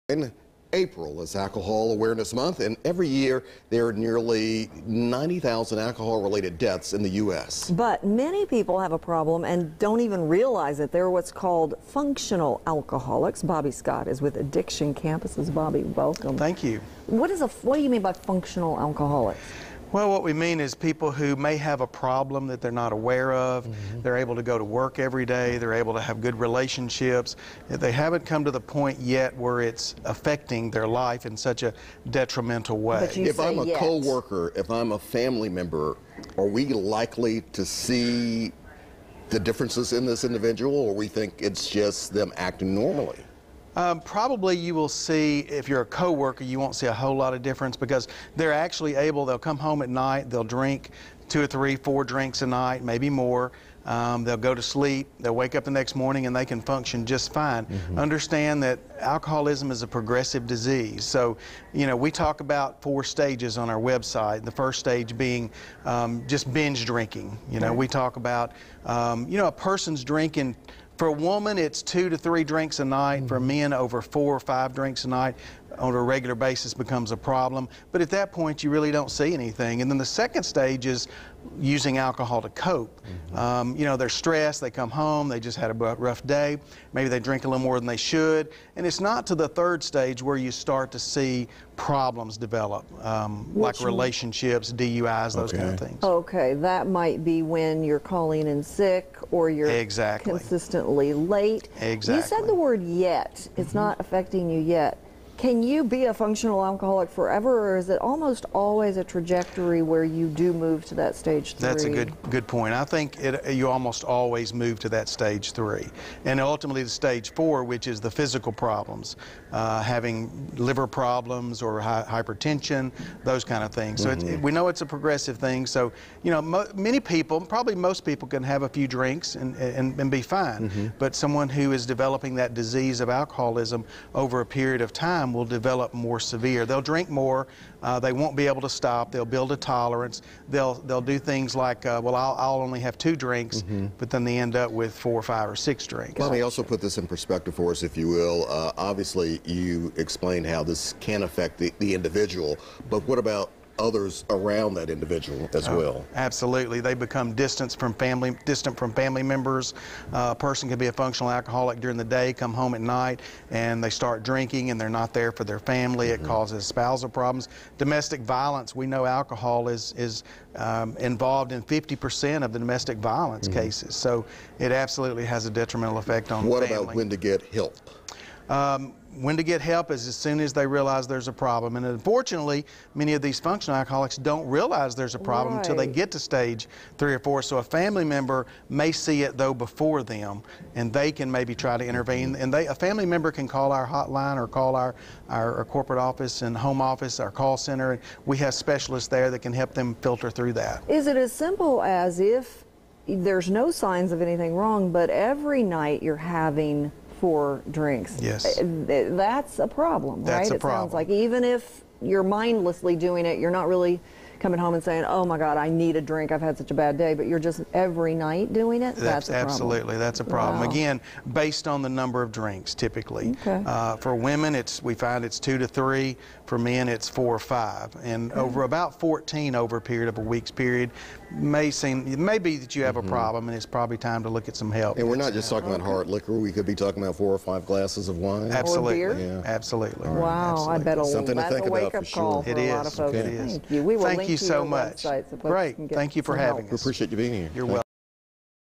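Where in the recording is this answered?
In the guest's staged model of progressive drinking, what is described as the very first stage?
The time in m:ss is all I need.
1:06.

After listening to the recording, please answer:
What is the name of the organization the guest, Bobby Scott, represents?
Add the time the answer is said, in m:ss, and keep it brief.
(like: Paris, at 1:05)
Addiction Campuses, at 0:14.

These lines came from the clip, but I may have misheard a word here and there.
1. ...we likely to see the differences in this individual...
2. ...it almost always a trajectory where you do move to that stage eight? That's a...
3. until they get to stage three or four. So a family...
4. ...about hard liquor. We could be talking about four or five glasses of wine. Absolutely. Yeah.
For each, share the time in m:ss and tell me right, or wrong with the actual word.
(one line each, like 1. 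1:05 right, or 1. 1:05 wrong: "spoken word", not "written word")
1. 0:36 right
2. 1:47 wrong: "three", not "eight"
3. 3:05 right
4. 3:55 right.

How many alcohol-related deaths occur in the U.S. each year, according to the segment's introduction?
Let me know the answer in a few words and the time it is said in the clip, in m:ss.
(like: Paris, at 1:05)
90,000, at 0:04.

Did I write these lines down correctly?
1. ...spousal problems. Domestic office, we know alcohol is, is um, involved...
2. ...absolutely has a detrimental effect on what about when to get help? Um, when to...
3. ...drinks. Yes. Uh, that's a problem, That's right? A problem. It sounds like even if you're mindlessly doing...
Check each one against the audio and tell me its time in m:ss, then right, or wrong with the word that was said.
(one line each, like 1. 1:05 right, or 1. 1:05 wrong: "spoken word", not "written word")
1. 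2:46 wrong: "violence", not "office"
2. 2:54 right
3. 3:27 right.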